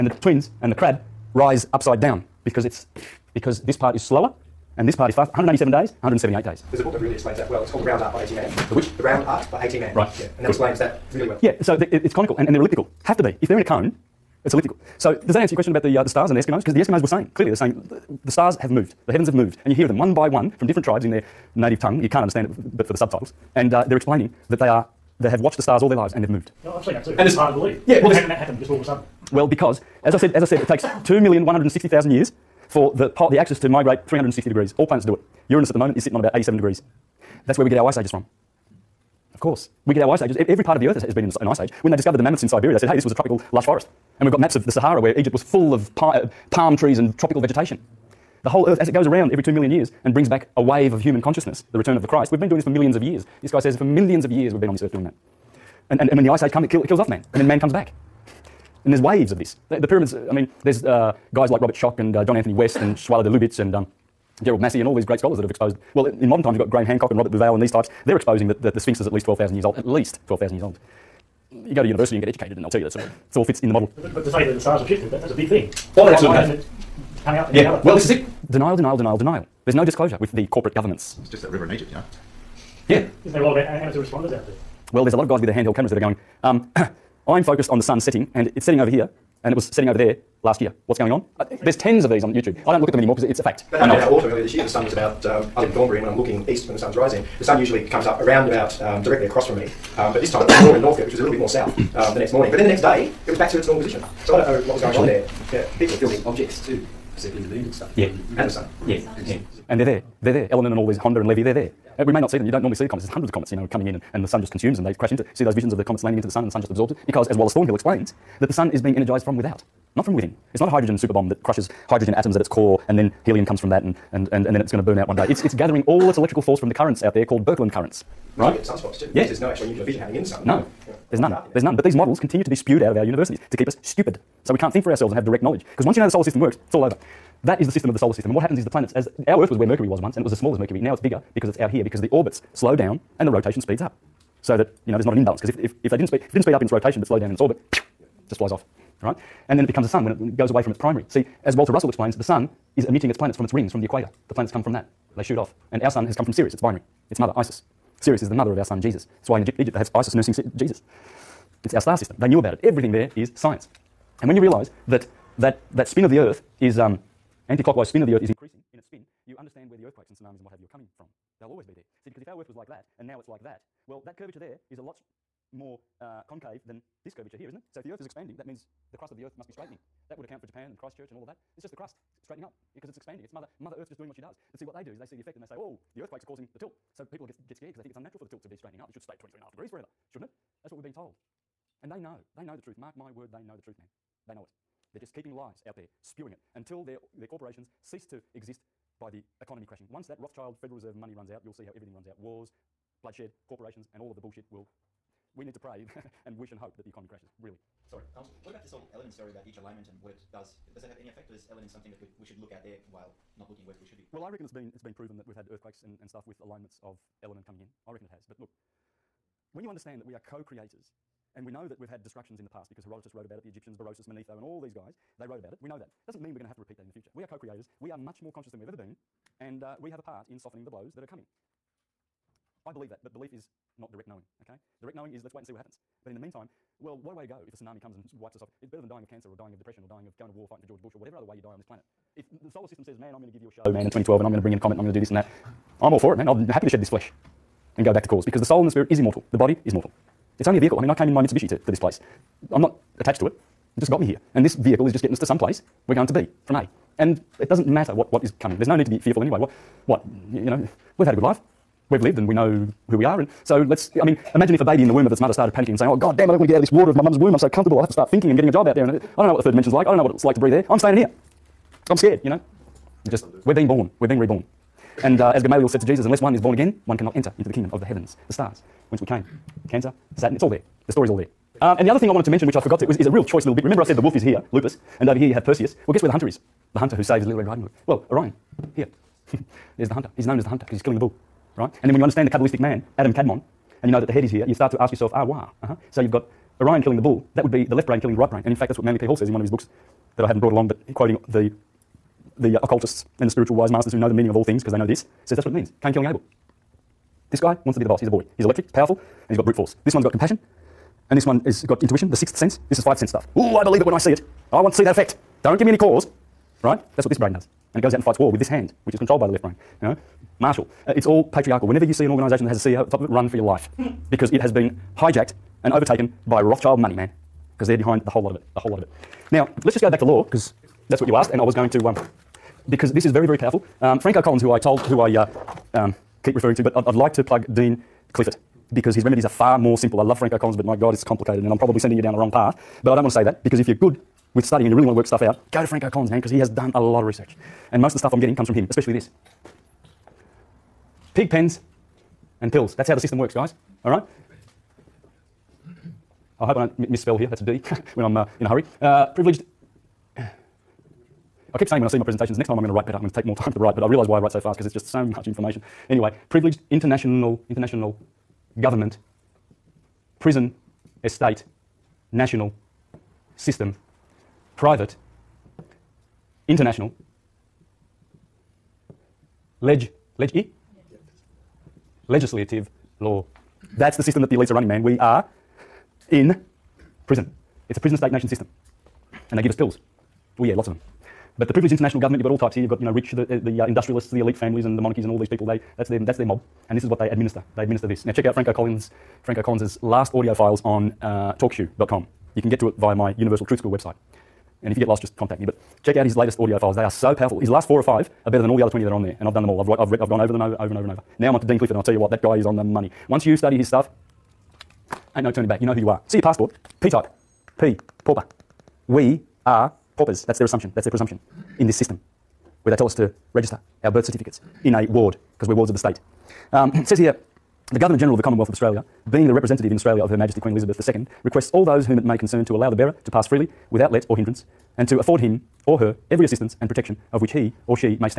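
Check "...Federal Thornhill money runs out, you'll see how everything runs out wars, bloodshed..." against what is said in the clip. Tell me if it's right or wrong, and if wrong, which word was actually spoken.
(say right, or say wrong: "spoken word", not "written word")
wrong: "Reserve", not "Thornhill".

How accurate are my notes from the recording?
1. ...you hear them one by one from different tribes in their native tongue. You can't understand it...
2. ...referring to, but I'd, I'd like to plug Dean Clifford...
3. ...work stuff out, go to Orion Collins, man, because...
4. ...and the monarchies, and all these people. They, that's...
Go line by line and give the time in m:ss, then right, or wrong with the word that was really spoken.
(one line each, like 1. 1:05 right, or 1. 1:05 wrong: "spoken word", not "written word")
1. 0:19 right
2. 5:36 right
3. 5:44 wrong: "Franco", not "Orion"
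4. 6:34 right.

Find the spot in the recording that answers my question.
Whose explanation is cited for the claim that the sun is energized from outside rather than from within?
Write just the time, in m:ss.
1:57.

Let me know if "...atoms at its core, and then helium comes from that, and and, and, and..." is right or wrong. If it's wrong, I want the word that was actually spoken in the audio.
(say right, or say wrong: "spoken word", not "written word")
right.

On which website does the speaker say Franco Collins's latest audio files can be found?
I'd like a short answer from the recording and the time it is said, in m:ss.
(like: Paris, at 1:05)
talkshoe.com, at 6:41.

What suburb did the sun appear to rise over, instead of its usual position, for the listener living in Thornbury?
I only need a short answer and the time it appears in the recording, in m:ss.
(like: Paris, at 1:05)
Northcote, at 1:40.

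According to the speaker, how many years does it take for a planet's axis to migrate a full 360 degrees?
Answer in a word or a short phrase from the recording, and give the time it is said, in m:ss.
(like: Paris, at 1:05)
2,160,000, at 0:30.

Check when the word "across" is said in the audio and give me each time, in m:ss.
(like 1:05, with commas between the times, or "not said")
1:39.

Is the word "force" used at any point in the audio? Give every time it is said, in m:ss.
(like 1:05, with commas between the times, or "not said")
2:06, 5:09.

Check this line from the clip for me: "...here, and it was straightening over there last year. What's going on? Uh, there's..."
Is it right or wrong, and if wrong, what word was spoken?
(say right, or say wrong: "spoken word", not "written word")
wrong: "setting", not "straightening".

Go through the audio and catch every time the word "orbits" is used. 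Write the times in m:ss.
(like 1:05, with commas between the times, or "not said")
2:22, 2:27.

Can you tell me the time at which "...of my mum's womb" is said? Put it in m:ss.
4:26.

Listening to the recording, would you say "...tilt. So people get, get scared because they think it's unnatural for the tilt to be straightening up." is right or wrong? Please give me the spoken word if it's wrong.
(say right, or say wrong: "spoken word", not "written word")
right.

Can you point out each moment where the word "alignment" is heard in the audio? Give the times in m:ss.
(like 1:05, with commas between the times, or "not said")
3:29, 3:36.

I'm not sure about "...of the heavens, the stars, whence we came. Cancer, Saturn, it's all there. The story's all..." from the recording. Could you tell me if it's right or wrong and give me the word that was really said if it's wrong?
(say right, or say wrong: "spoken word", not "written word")
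right.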